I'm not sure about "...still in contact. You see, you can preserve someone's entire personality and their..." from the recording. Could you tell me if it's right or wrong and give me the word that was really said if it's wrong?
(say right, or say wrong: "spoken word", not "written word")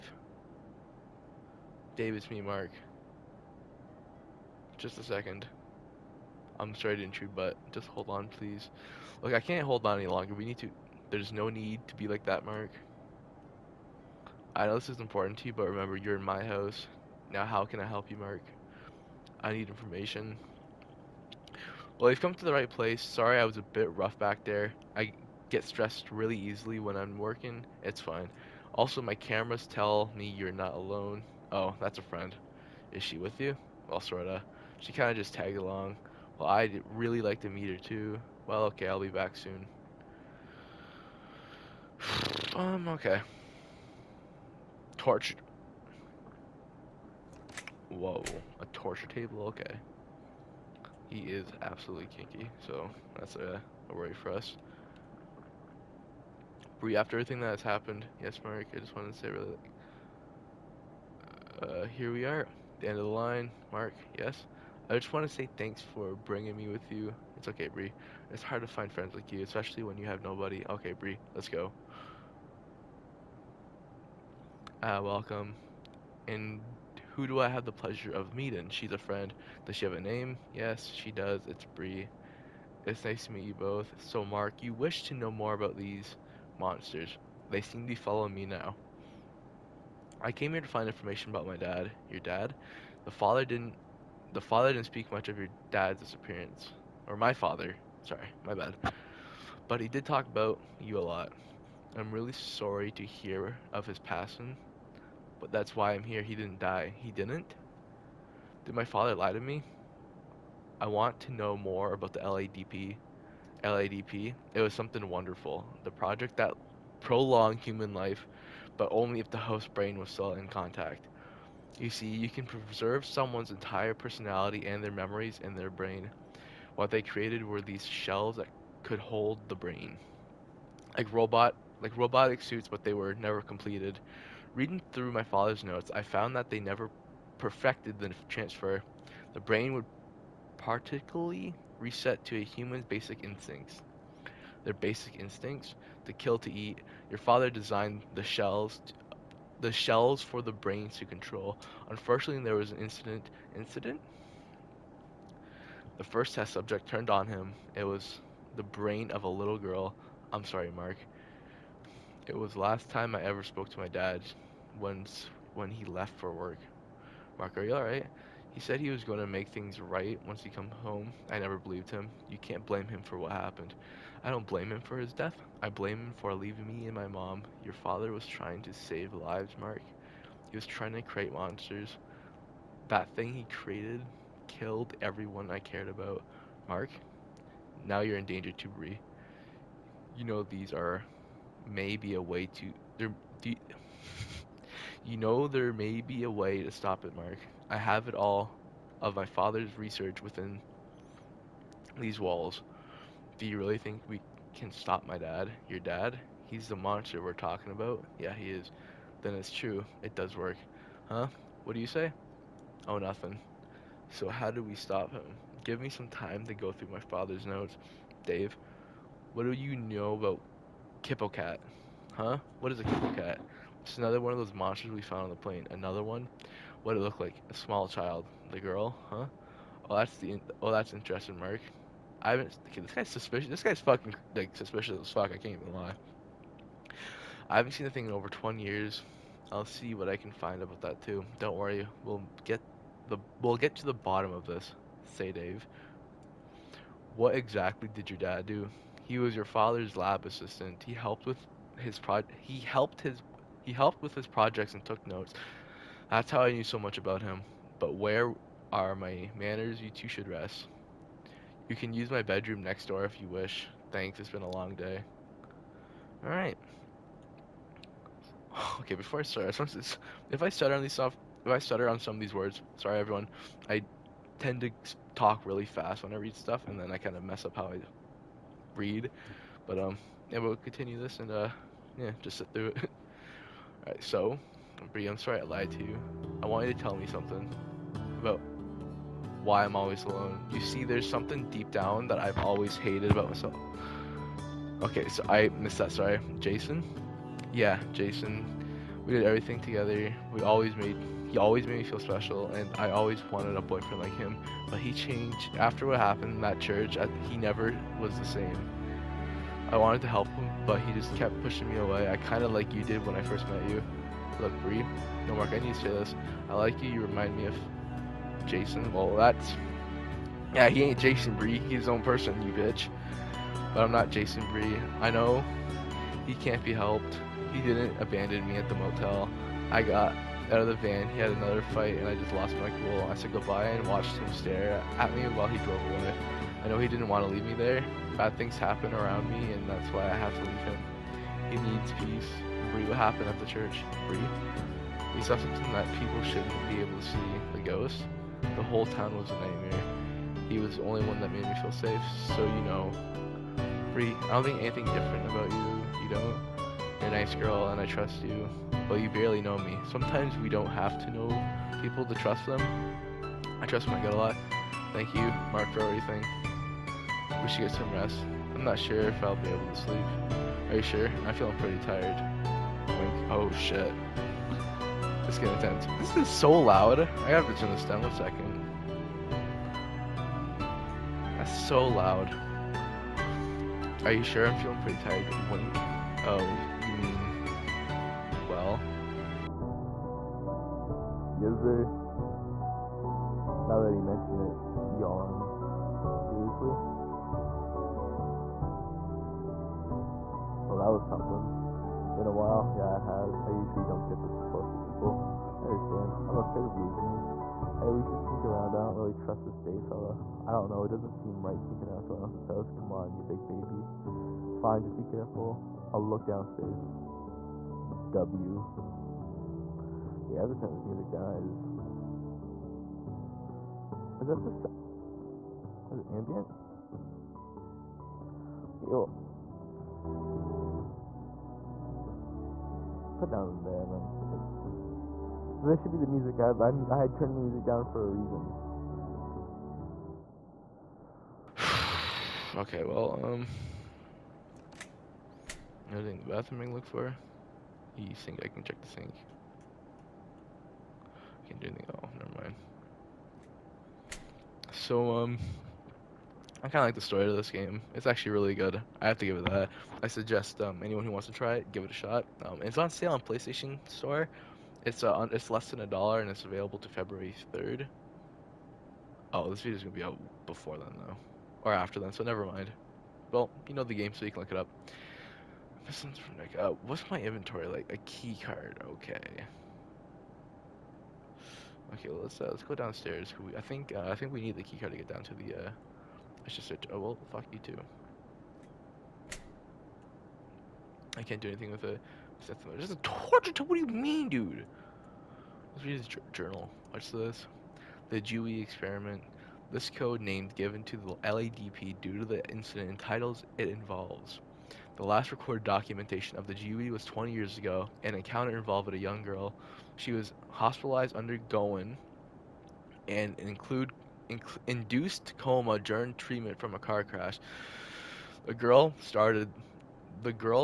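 right.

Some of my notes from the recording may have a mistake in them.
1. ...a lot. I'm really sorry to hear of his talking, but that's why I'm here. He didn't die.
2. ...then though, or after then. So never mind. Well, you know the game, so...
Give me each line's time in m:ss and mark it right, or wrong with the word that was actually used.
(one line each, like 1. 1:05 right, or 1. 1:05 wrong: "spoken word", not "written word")
1. 1:40 wrong: "passing", not "talking"
2. 7:50 right.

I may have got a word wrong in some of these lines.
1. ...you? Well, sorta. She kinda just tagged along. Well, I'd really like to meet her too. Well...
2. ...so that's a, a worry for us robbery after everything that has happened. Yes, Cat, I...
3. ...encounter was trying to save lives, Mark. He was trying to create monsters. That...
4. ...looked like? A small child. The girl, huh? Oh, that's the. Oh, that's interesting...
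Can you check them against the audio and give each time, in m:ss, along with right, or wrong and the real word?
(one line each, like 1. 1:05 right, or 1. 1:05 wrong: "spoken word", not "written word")
1. 0:33 right
2. 0:52 wrong: "Mark", not "Cat"
3. 2:57 wrong: "father", not "encounter"
4. 3:46 right.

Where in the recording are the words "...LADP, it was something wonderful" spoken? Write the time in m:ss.
1:53.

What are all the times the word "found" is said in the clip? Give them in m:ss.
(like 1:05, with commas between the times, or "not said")
2:16, 3:44.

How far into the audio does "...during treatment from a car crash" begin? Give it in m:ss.
8:35.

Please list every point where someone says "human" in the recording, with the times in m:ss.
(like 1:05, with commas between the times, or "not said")
1:57, 2:22.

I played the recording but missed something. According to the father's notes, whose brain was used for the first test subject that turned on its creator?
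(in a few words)
A little girl.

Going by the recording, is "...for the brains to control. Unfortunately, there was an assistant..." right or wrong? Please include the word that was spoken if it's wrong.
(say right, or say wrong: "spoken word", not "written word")
wrong: "incident", not "assistant".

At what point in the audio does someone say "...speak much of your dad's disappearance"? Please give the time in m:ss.
1:34.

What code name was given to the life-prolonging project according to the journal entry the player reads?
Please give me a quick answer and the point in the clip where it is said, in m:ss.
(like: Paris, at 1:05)
The Dewey experiment, at 8:18.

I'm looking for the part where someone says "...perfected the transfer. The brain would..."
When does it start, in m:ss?
2:17.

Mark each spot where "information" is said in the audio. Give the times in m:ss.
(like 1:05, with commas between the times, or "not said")
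0:19, 1:30.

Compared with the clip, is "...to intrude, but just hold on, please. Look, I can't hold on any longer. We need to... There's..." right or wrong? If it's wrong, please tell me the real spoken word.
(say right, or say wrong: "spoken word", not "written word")
right.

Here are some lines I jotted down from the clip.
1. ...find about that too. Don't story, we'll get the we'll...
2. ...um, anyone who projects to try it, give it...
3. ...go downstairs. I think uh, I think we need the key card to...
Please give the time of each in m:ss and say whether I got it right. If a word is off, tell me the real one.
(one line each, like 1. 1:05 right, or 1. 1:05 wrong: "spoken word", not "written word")
1. 4:00 wrong: "worry", not "story"
2. 7:40 wrong: "wants", not "projects"
3. 8:02 right.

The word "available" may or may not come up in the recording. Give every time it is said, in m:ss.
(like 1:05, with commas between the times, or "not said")
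7:46.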